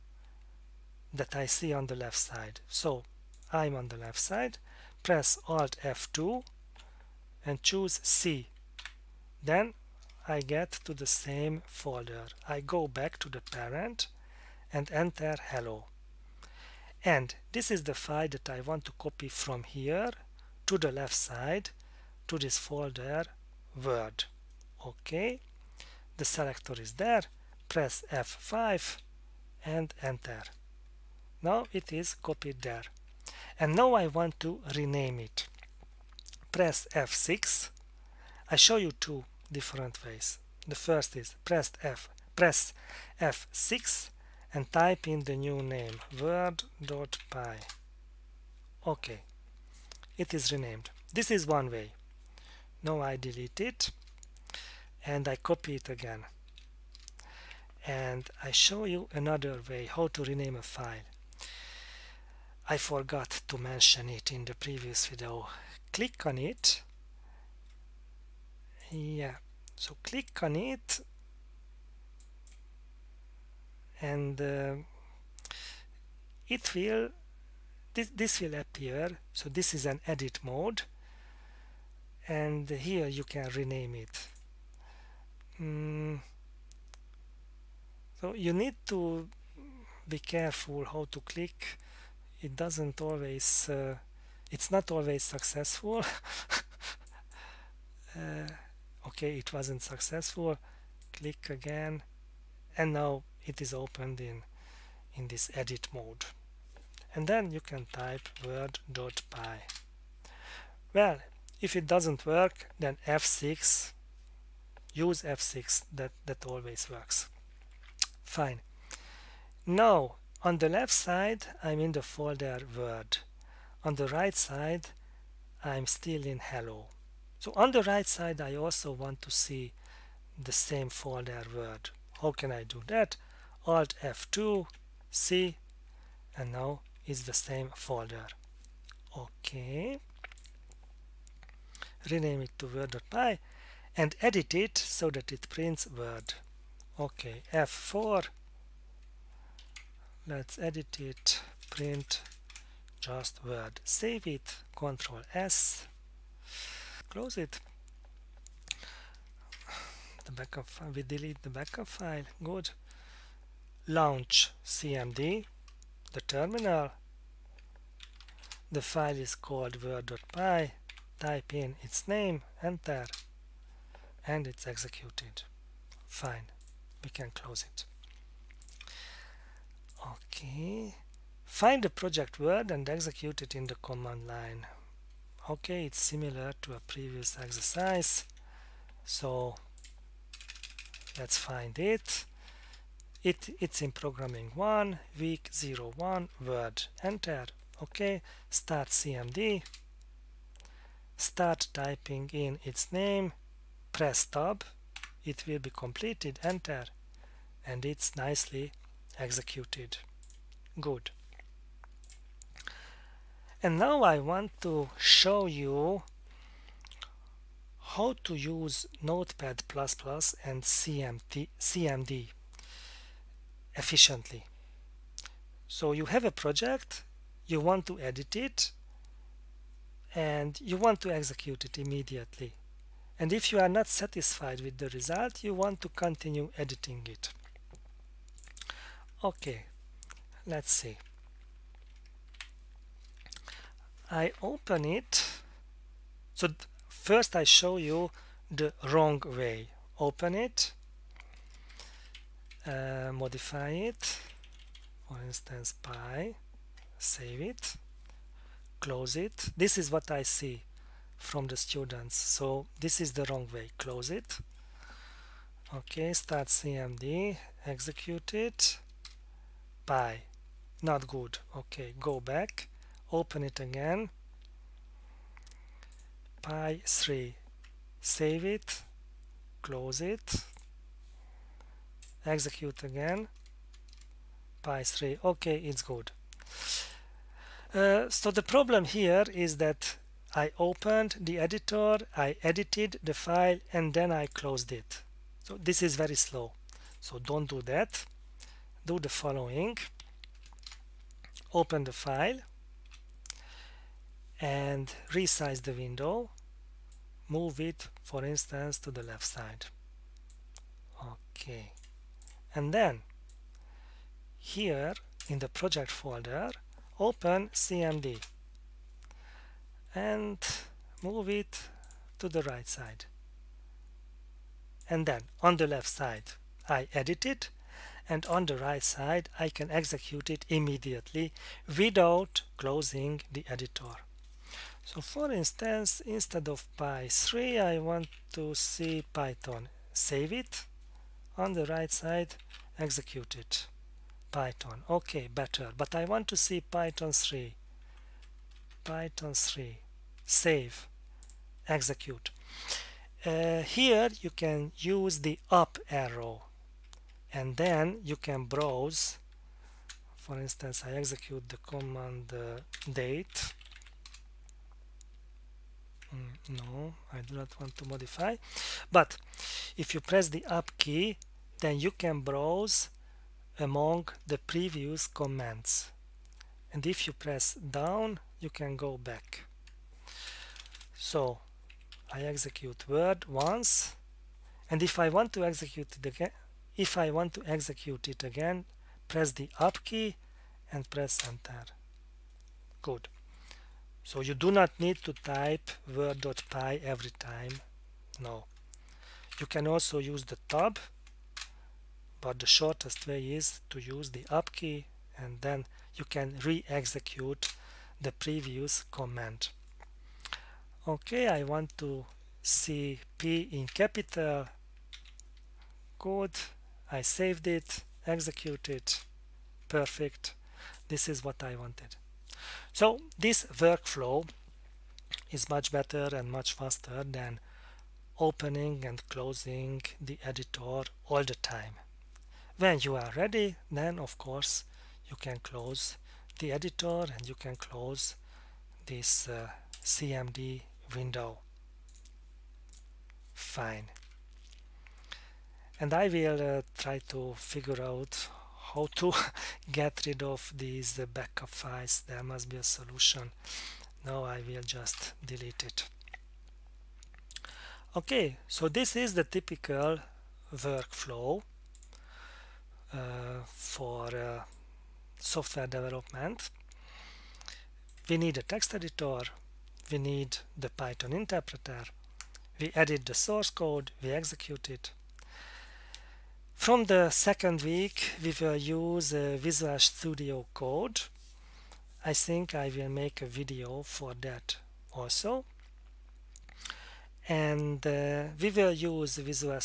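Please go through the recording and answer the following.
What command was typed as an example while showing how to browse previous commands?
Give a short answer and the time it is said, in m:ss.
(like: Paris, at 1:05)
date, at 6:02.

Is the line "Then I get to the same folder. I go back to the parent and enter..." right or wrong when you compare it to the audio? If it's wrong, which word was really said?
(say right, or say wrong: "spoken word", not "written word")
right.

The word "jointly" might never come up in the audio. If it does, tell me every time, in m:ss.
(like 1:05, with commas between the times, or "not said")
not said.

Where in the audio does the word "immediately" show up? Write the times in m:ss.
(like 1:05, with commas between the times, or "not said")
3:51, 5:30.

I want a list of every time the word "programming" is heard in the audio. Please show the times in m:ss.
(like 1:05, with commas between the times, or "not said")
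3:13.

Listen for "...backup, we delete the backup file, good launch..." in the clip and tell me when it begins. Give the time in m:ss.
2:40.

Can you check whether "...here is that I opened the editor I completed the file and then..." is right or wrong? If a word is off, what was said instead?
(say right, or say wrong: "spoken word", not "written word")
wrong: "edited", not "completed".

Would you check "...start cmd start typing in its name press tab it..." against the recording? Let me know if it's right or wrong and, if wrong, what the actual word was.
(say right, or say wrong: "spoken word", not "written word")
right.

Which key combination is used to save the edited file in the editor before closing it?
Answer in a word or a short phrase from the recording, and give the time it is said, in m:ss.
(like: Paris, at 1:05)
Control S, at 2:34.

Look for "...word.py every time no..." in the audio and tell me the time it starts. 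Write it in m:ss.
6:35.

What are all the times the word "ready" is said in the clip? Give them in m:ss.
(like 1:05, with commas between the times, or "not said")
7:13.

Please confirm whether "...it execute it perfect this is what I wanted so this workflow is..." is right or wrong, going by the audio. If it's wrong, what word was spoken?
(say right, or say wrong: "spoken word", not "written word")
right.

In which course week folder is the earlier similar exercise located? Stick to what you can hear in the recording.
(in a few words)
week zero one.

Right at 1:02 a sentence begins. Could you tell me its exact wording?
I forgot to mention it in the previous video.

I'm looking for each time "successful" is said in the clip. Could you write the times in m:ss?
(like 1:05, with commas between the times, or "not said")
1:35, 1:39.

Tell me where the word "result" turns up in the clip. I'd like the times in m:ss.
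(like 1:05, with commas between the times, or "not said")
3:54.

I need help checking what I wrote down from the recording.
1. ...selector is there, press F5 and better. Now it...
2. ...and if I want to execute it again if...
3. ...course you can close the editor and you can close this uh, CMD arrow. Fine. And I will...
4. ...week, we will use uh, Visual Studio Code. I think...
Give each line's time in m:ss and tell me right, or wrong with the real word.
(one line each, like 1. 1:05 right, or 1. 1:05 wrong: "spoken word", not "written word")
1. 0:26 wrong: "enter", not "better"
2. 6:24 right
3. 7:14 wrong: "window", not "arrow"
4. 7:57 right.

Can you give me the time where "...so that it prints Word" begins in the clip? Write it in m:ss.
2:24.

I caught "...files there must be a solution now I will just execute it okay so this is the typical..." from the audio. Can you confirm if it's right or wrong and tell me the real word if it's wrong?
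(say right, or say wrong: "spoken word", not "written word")
wrong: "delete", not "execute".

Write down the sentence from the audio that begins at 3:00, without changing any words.
Okay, find the project word and execute it in the command line.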